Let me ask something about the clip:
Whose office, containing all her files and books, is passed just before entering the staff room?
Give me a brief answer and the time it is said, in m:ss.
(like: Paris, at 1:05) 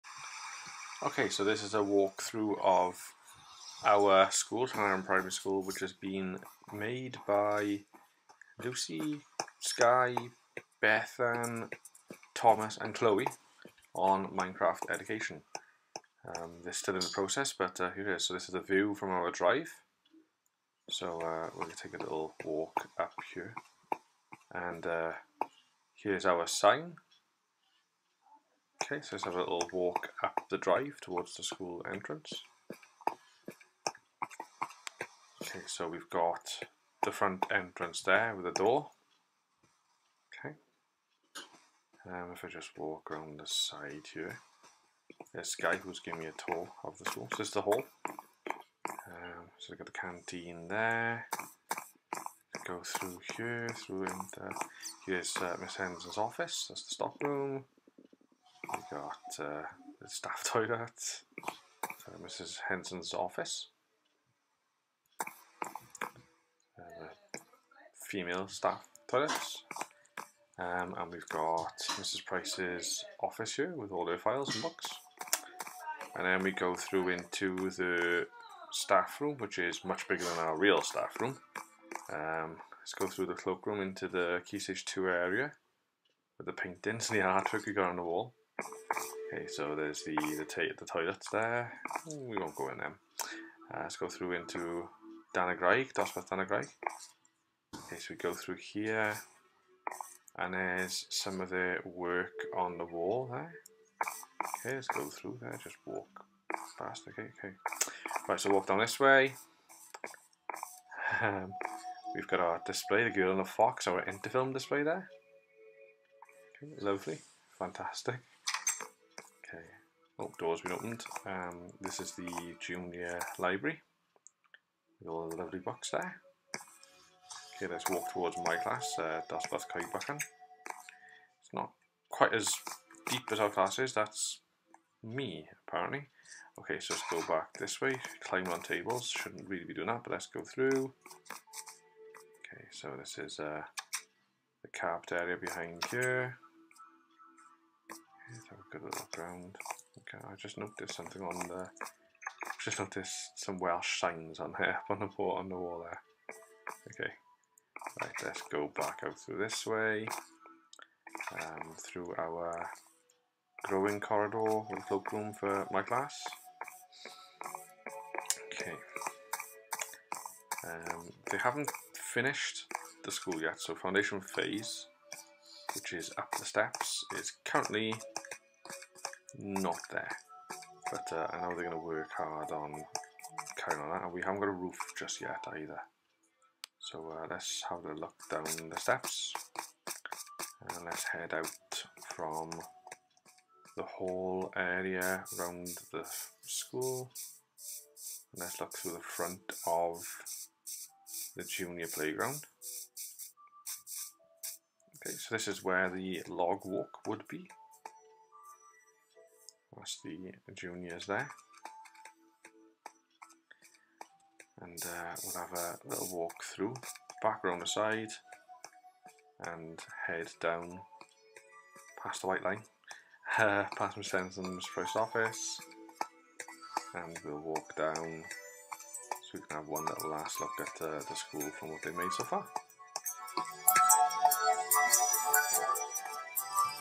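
Mrs. Price, at 1:11.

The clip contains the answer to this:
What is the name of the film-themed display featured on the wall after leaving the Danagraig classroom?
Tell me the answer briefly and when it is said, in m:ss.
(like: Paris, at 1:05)
The Girl and the Fox, at 1:53.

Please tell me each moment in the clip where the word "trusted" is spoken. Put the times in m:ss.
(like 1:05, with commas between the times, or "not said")
not said.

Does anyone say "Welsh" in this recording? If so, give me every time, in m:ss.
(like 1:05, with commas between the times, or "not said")
2:33.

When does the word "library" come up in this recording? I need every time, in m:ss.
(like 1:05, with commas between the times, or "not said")
2:03.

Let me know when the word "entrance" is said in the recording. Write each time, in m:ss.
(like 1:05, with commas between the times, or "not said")
0:31, 0:37.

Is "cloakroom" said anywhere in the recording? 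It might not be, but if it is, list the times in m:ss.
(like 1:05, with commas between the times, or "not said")
1:23, 2:44.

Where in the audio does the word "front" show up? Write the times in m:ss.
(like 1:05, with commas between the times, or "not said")
0:37, 3:18.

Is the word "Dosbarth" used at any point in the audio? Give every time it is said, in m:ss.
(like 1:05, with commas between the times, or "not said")
1:35, 2:09.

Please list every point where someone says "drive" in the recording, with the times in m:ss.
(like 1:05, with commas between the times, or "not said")
0:19, 0:30.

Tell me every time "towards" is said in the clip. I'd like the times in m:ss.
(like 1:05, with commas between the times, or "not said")
0:30, 2:08.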